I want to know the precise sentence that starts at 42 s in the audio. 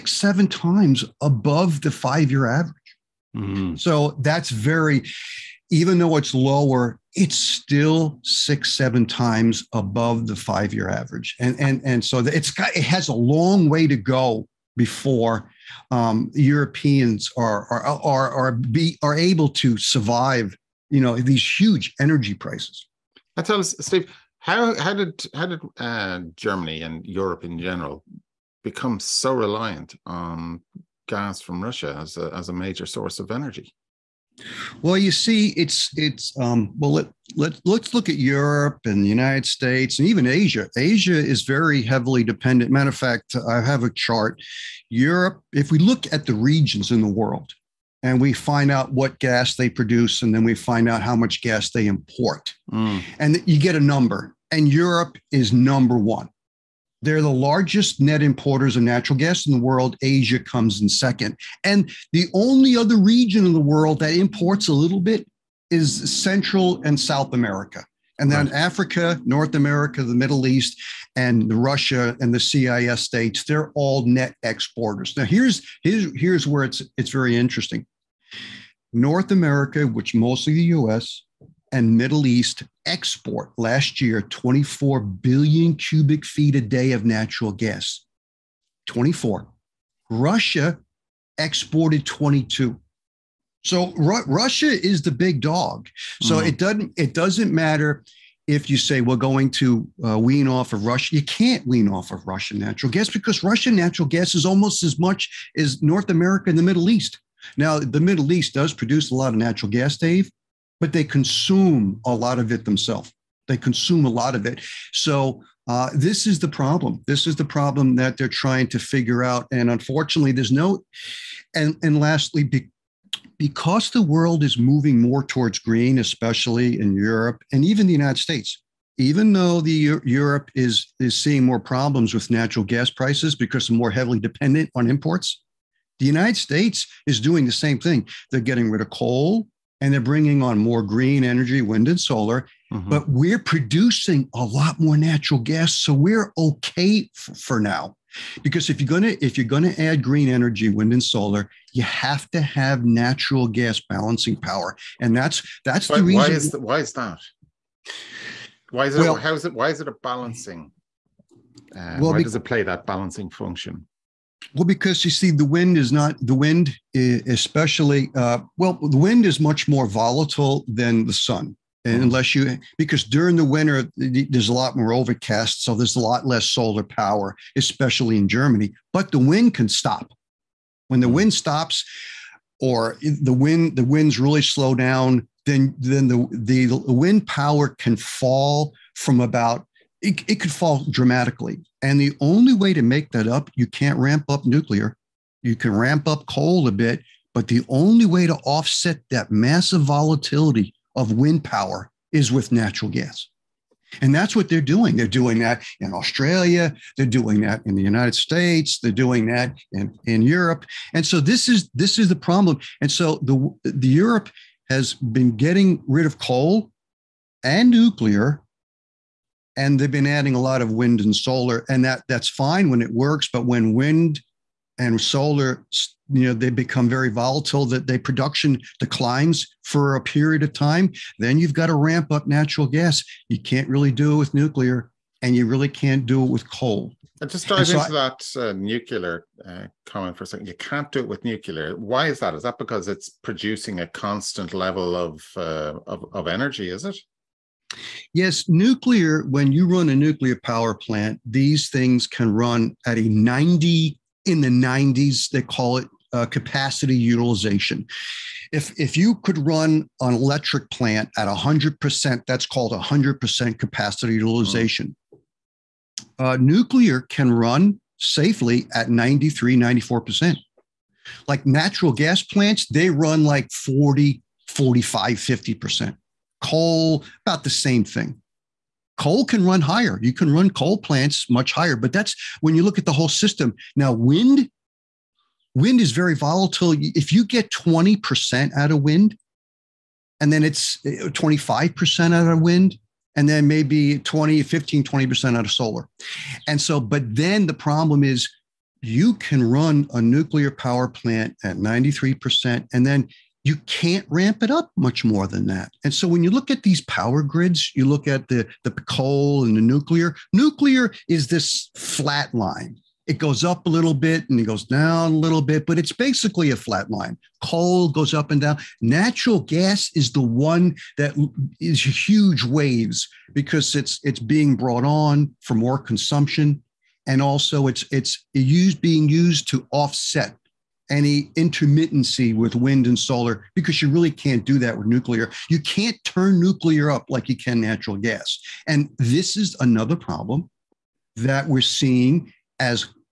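Matter of fact, I have a chart.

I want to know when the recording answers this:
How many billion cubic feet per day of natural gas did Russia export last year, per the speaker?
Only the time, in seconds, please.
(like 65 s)
92 s.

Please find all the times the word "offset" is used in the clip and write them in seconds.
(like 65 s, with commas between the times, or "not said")
198 s, 329 s.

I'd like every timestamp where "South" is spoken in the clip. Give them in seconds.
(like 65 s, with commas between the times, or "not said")
66 s.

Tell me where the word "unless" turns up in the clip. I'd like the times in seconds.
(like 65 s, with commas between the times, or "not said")
172 s.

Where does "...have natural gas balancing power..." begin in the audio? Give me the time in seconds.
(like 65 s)
152 s.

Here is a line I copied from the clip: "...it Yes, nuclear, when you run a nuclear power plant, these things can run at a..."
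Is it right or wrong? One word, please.
right.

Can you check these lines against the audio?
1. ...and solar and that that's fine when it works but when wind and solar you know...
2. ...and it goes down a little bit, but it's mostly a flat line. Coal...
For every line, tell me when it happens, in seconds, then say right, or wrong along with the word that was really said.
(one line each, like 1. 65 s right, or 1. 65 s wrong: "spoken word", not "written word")
1. 221 s right
2. 314 s wrong: "basically", not "mostly".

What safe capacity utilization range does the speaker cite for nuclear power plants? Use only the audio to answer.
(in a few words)
93 to 94%.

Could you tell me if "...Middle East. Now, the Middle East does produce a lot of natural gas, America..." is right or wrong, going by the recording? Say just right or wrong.
wrong.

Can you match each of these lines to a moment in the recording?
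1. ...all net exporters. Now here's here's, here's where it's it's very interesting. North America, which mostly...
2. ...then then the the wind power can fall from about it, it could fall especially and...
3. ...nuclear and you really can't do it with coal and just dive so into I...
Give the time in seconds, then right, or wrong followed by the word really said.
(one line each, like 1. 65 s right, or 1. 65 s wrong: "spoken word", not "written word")
1. 73 s right
2. 185 s wrong: "dramatically", not "especially"
3. 234 s right.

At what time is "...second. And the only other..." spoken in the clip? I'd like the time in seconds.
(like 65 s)
60 s.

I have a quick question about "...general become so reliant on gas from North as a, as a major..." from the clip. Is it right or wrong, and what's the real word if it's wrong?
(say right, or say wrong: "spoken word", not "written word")
wrong: "Russia", not "North".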